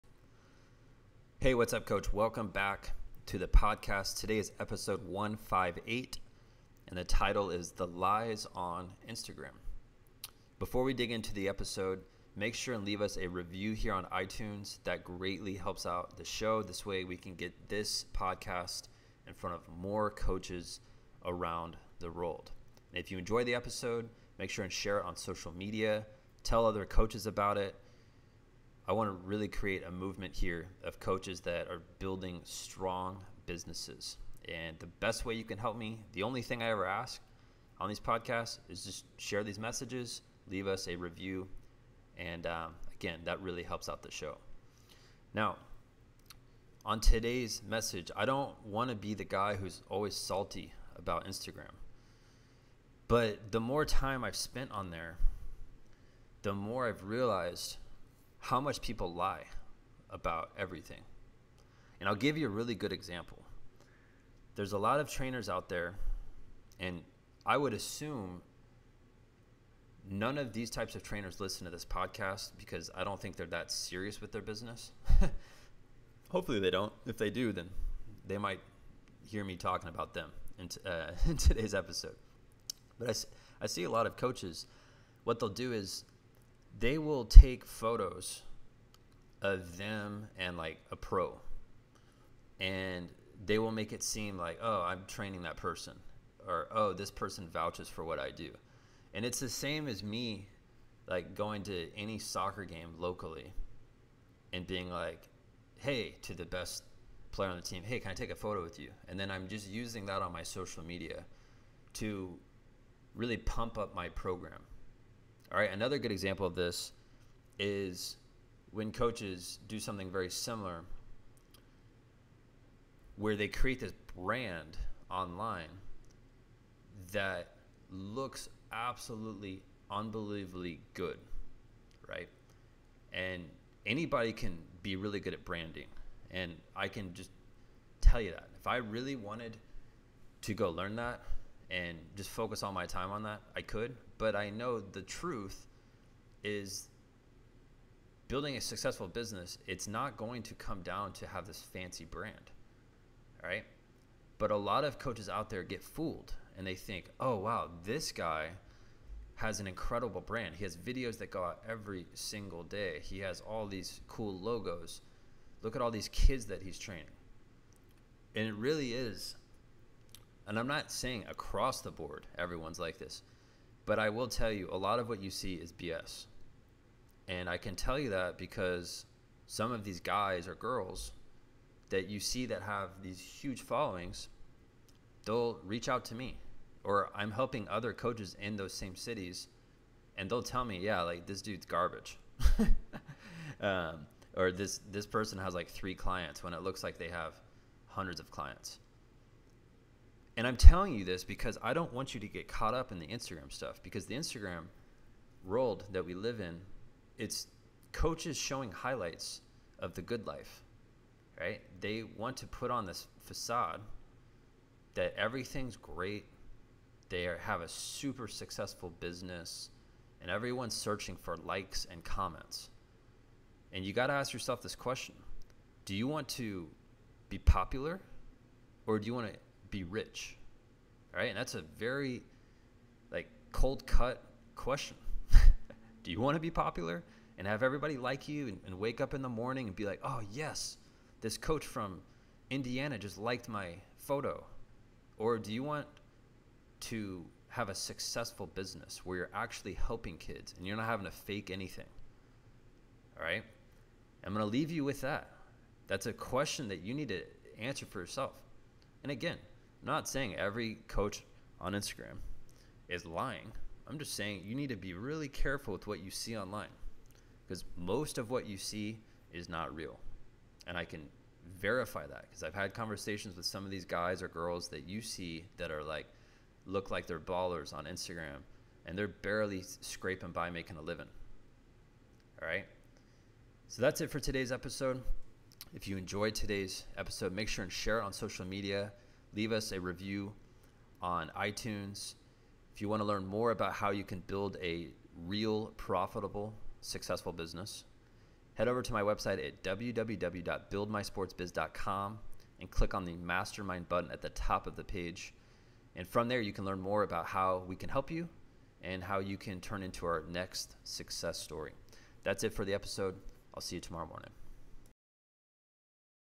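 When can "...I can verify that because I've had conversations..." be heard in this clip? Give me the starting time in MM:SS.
04:30.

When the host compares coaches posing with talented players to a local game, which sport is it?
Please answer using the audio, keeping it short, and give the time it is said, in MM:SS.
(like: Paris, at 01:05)
soccer, at 01:42.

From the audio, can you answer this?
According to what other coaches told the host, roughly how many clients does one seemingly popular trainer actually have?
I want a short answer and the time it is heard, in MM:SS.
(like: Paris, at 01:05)
3, at 03:15.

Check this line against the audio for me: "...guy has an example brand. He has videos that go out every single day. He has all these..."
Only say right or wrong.
wrong.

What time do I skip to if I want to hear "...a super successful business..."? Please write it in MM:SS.
03:37.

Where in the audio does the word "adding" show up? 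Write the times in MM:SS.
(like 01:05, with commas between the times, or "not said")
not said.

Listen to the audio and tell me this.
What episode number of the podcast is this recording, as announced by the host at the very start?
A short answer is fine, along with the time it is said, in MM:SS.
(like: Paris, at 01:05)
158, at 00:04.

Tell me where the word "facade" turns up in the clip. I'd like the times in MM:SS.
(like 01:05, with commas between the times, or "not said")
03:33.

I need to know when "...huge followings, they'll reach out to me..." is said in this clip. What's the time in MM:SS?
03:03.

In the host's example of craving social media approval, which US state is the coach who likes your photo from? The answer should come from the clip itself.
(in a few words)
Indiana.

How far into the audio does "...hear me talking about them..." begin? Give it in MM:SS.
01:19.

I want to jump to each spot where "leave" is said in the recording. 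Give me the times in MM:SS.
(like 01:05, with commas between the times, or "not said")
00:12, 00:40, 04:14, 04:49.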